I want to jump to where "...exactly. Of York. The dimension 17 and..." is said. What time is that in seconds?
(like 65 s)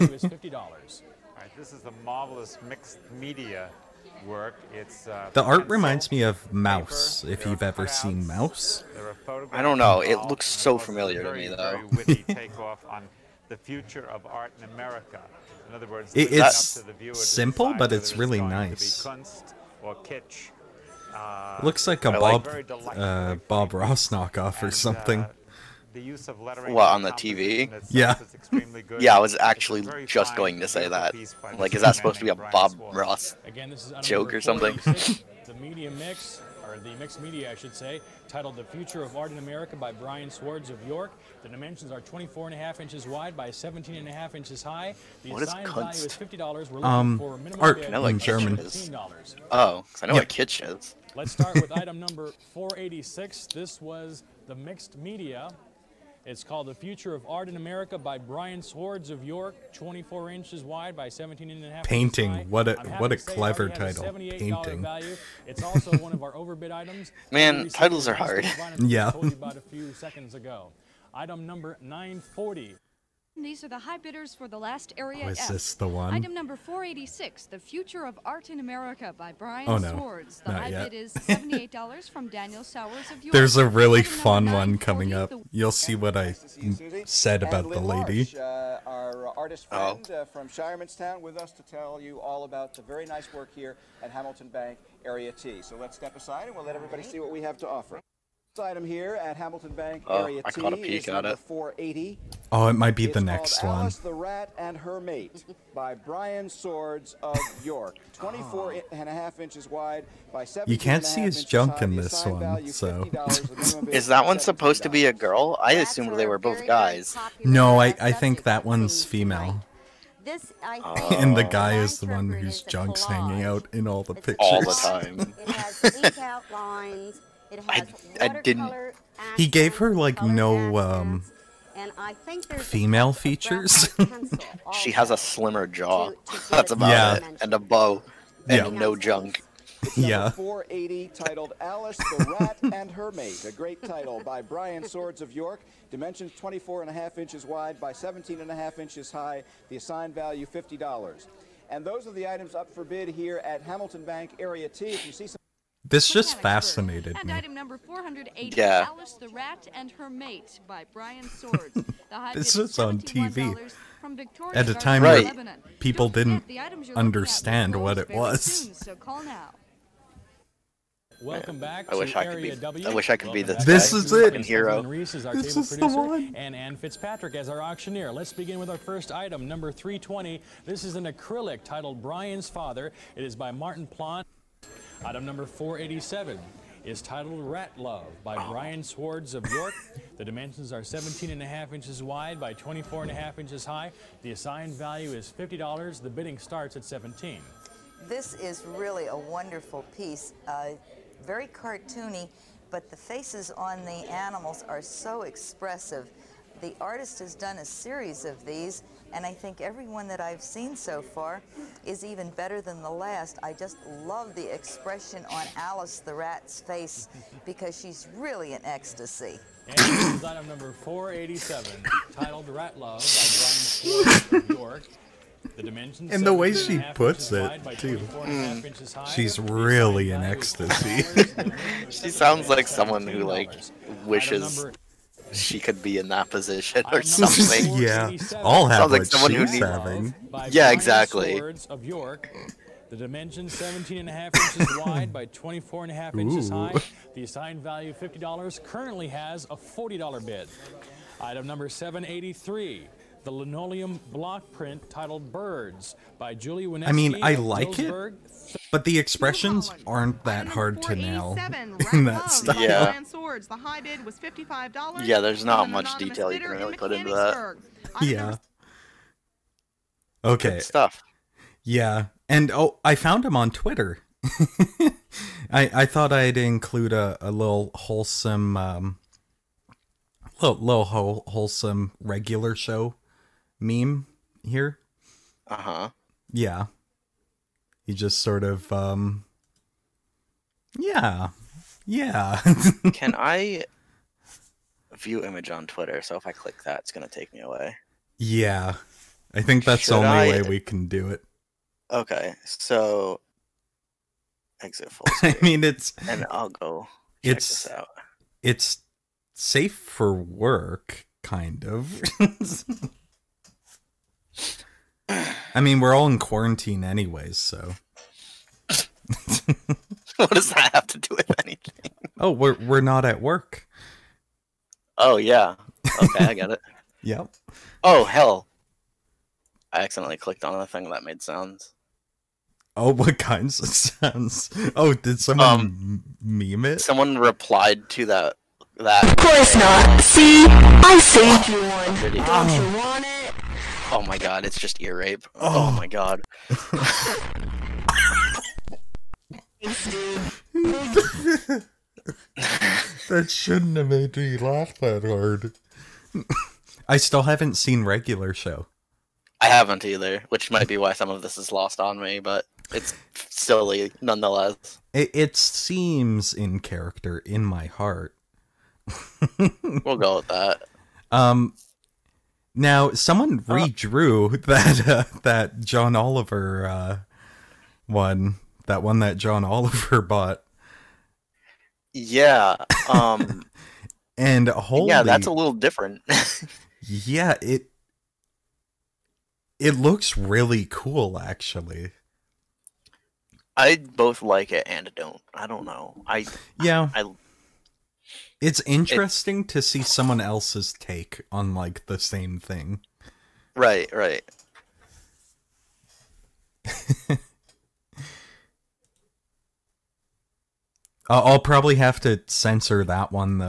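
240 s.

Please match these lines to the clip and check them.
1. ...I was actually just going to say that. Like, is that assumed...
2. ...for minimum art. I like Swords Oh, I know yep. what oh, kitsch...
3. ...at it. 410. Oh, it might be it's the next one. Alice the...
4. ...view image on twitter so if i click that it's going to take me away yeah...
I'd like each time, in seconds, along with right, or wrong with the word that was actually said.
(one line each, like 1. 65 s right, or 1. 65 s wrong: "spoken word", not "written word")
1. 29 s wrong: "supposed", not "assumed"
2. 47 s wrong: "German", not "Swords"
3. 101 s wrong: "480", not "410"
4. 294 s right.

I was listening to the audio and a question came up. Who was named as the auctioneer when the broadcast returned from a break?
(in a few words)
Ann Fitzpatrick.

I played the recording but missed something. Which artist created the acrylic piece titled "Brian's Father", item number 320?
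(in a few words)
Martin Plant.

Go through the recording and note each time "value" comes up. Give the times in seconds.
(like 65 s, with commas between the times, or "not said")
150 s, 194 s, 247 s.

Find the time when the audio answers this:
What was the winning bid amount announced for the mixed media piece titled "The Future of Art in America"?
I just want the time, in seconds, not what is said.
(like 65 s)
81 s.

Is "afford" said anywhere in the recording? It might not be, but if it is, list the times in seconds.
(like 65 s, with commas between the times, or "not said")
not said.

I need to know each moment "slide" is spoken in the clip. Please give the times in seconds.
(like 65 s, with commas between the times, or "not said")
not said.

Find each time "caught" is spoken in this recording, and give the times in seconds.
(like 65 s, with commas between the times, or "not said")
100 s.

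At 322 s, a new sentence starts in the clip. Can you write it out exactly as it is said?
Oh, we're we're not at work.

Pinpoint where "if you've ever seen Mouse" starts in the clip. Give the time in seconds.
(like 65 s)
7 s.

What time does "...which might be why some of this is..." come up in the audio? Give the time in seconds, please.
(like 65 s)
360 s.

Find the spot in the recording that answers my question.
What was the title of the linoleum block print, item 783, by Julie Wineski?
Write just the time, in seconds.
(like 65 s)
255 s.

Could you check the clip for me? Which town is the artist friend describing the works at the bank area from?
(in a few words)
Shiremanstown.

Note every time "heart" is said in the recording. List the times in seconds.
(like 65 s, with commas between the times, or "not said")
367 s.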